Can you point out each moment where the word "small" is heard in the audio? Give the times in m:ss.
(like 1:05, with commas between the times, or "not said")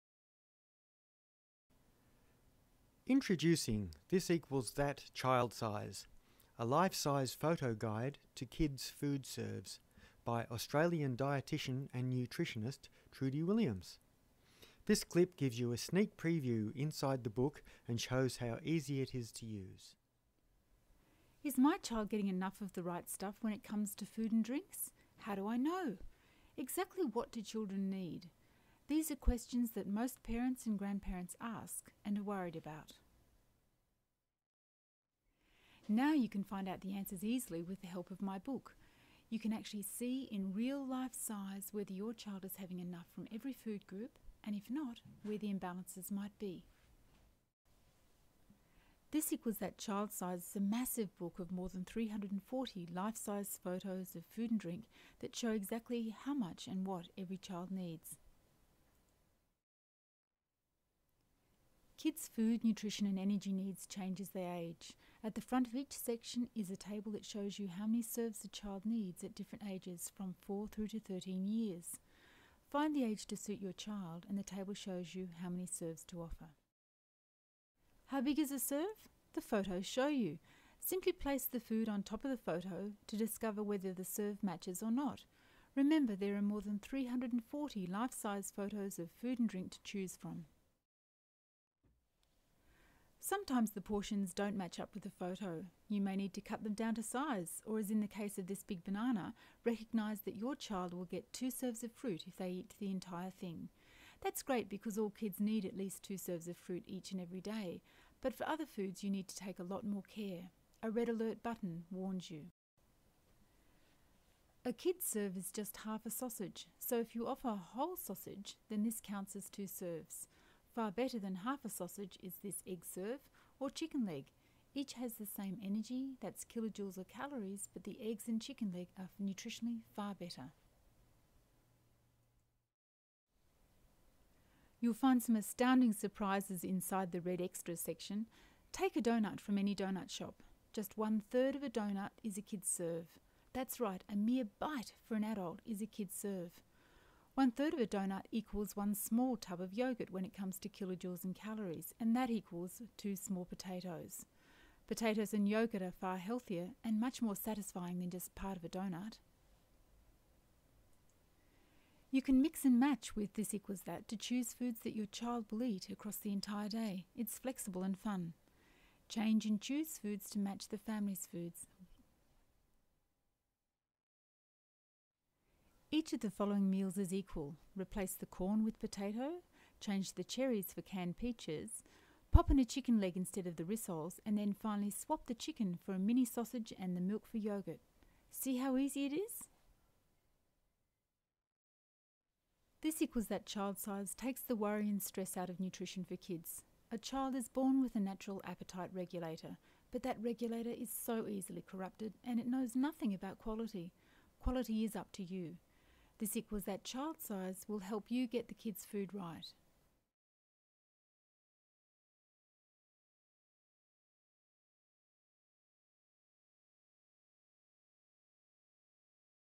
2:28, 2:33.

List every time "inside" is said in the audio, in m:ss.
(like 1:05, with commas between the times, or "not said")
0:16, 2:16.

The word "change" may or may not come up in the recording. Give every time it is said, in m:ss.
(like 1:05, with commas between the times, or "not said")
1:03, 2:49, 2:59.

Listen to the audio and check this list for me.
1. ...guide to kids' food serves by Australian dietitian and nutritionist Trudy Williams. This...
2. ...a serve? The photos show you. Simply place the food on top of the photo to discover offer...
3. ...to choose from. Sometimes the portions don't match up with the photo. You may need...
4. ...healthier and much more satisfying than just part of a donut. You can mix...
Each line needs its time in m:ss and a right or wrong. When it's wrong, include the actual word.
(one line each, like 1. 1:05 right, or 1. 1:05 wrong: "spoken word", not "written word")
1. 0:07 right
2. 1:18 wrong: "whether", not "offer"
3. 1:29 right
4. 2:36 right.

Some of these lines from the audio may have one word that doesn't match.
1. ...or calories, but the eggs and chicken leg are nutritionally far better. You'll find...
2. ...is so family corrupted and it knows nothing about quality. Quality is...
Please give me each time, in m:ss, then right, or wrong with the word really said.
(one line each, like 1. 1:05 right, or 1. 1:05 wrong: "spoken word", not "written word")
1. 2:06 right
2. 3:20 wrong: "easily", not "family".